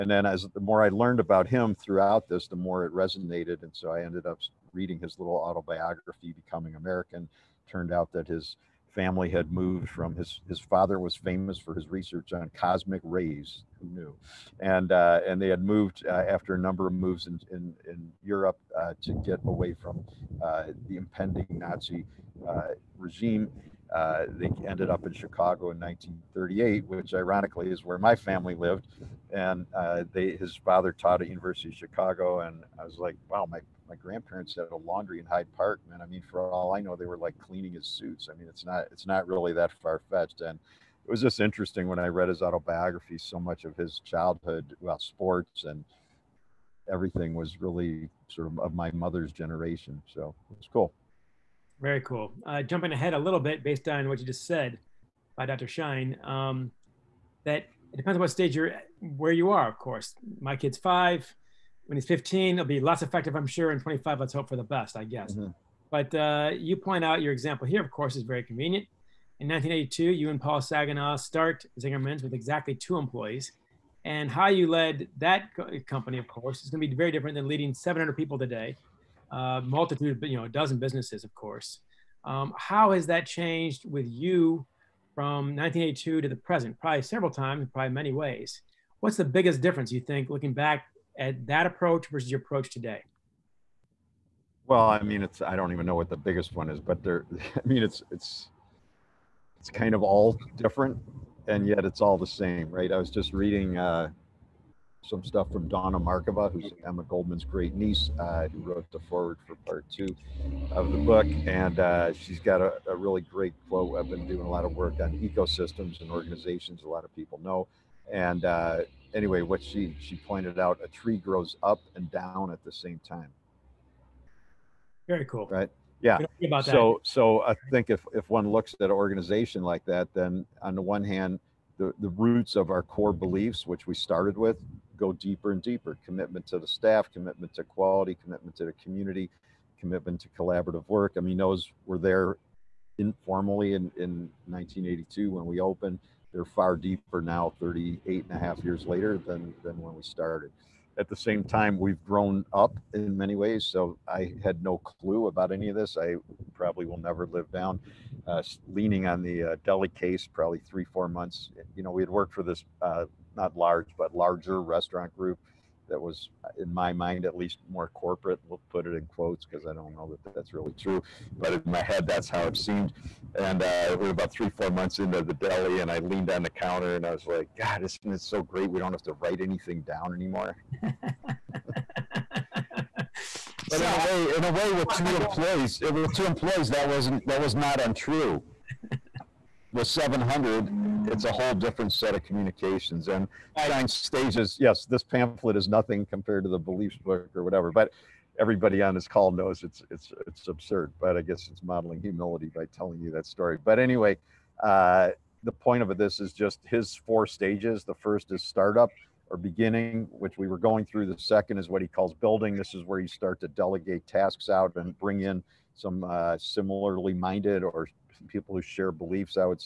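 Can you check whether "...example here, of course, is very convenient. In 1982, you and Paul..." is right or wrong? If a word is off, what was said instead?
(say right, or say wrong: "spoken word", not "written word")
right.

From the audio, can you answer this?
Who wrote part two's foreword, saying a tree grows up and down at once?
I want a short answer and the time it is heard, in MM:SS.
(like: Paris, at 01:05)
Dawna Markova, at 01:45.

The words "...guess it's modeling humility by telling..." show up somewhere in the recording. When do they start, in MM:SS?
03:21.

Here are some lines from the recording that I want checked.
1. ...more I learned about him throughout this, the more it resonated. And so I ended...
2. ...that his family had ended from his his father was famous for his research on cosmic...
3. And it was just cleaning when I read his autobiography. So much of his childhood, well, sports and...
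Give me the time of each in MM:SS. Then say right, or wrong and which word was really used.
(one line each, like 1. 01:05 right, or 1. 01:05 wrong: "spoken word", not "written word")
1. 00:00 right
2. 00:08 wrong: "moved", not "ended"
3. 00:40 wrong: "interesting", not "cleaning".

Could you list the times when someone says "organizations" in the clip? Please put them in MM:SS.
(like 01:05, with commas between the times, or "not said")
01:56, 02:08.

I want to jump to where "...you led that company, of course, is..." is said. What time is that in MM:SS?
01:14.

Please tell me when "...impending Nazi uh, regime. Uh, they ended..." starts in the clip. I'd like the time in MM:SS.
00:20.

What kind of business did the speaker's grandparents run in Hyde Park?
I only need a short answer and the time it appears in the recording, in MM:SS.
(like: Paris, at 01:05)
a laundry, at 00:34.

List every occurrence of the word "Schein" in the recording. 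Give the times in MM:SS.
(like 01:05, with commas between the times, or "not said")
00:55, 03:13.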